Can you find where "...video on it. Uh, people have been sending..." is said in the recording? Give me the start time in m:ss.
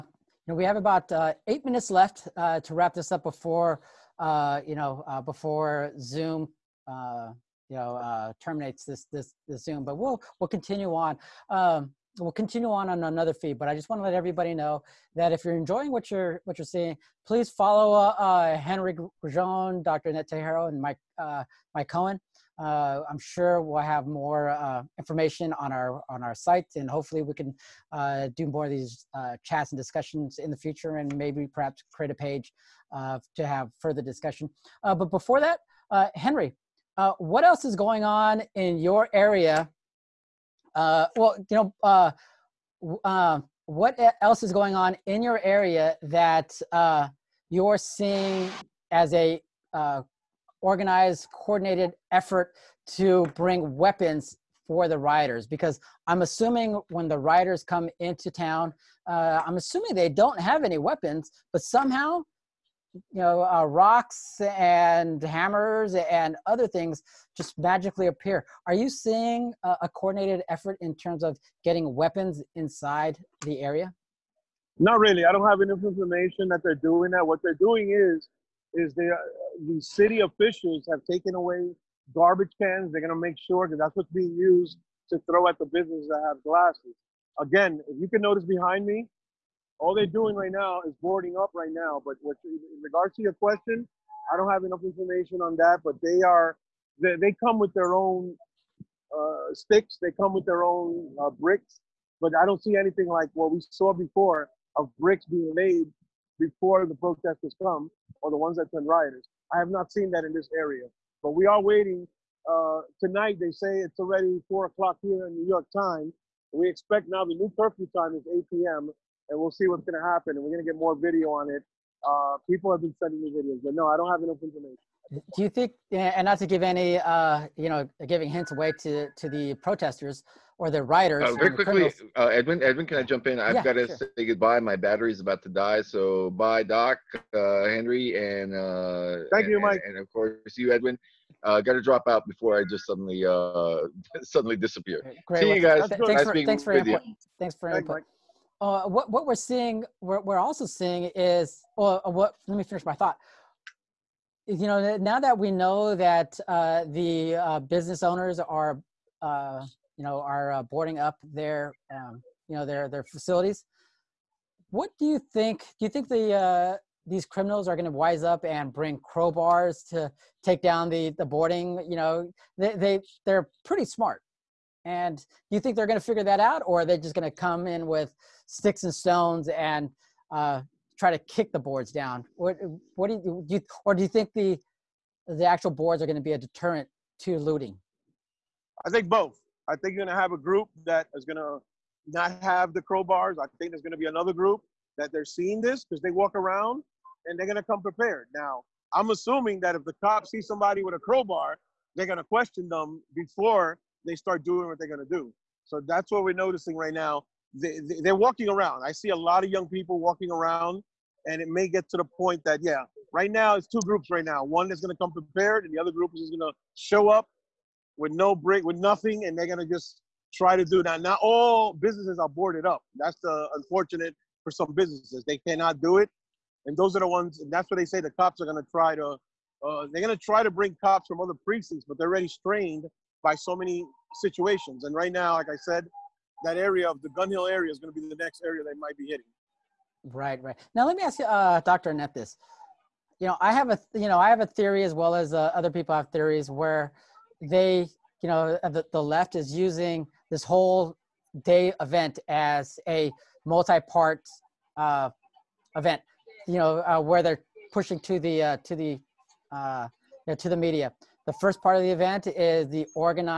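2:00.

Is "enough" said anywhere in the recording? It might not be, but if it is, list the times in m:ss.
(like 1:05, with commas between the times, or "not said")
1:15, 1:34, 2:04.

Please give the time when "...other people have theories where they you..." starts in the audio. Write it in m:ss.
4:05.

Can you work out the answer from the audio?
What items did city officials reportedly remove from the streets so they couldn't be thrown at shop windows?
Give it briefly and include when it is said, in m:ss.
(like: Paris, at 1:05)
garbage cans, at 1:22.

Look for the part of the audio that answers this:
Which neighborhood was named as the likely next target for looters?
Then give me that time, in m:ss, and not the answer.
3:57.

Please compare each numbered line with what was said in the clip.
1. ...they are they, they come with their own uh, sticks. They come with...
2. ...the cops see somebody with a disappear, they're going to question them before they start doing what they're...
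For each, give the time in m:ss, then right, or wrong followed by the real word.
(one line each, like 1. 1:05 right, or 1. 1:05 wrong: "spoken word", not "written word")
1. 1:36 right
2. 3:19 wrong: "crowbar", not "disappear".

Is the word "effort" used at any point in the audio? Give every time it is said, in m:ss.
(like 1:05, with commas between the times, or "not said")
0:52, 1:10.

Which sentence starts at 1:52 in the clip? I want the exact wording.
Uh, tonight they say it's already four o'clock here in New York time.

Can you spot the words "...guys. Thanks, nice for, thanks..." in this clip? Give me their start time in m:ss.
2:25.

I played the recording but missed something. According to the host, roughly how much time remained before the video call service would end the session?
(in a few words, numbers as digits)
8 minutes.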